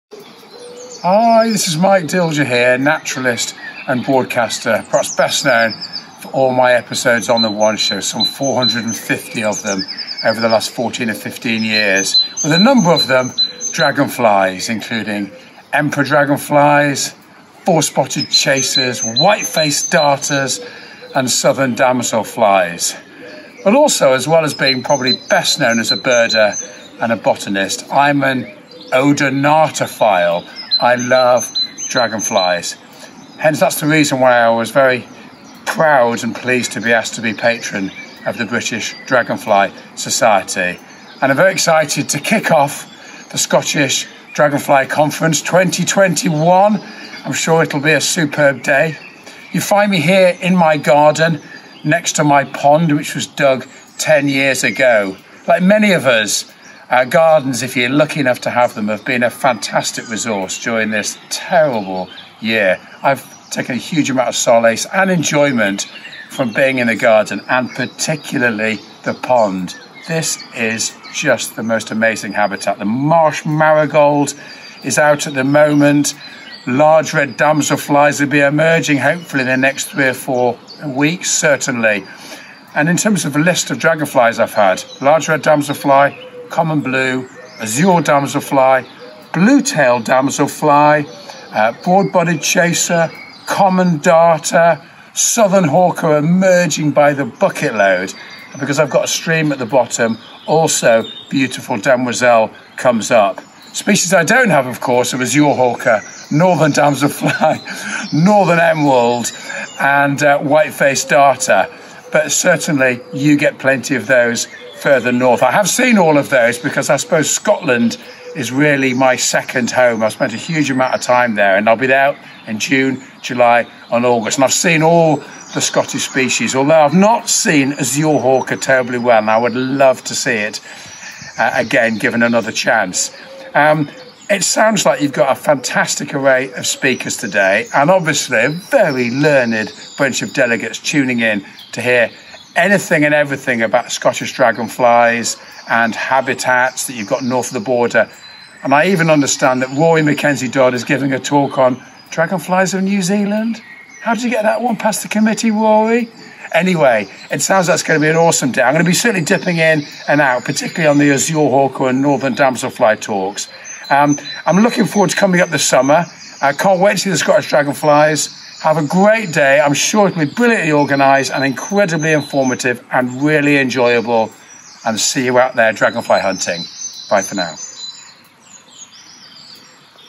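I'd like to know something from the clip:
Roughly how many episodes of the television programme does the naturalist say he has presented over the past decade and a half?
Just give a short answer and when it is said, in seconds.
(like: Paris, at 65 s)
450, at 8 s.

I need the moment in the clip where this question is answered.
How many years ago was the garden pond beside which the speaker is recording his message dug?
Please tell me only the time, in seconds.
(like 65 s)
53 s.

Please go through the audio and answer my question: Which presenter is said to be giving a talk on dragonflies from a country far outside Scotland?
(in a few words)
Rory Mackenzie Dodd.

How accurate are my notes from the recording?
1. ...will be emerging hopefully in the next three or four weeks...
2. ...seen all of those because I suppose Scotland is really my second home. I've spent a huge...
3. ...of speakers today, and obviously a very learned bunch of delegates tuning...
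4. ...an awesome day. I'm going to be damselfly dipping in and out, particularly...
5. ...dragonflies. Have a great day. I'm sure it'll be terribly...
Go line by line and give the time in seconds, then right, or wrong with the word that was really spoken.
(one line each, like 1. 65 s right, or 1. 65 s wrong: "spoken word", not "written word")
1. 78 s right
2. 115 s right
3. 136 s right
4. 158 s wrong: "certainly", not "damselfly"
5. 167 s wrong: "brilliantly", not "terribly".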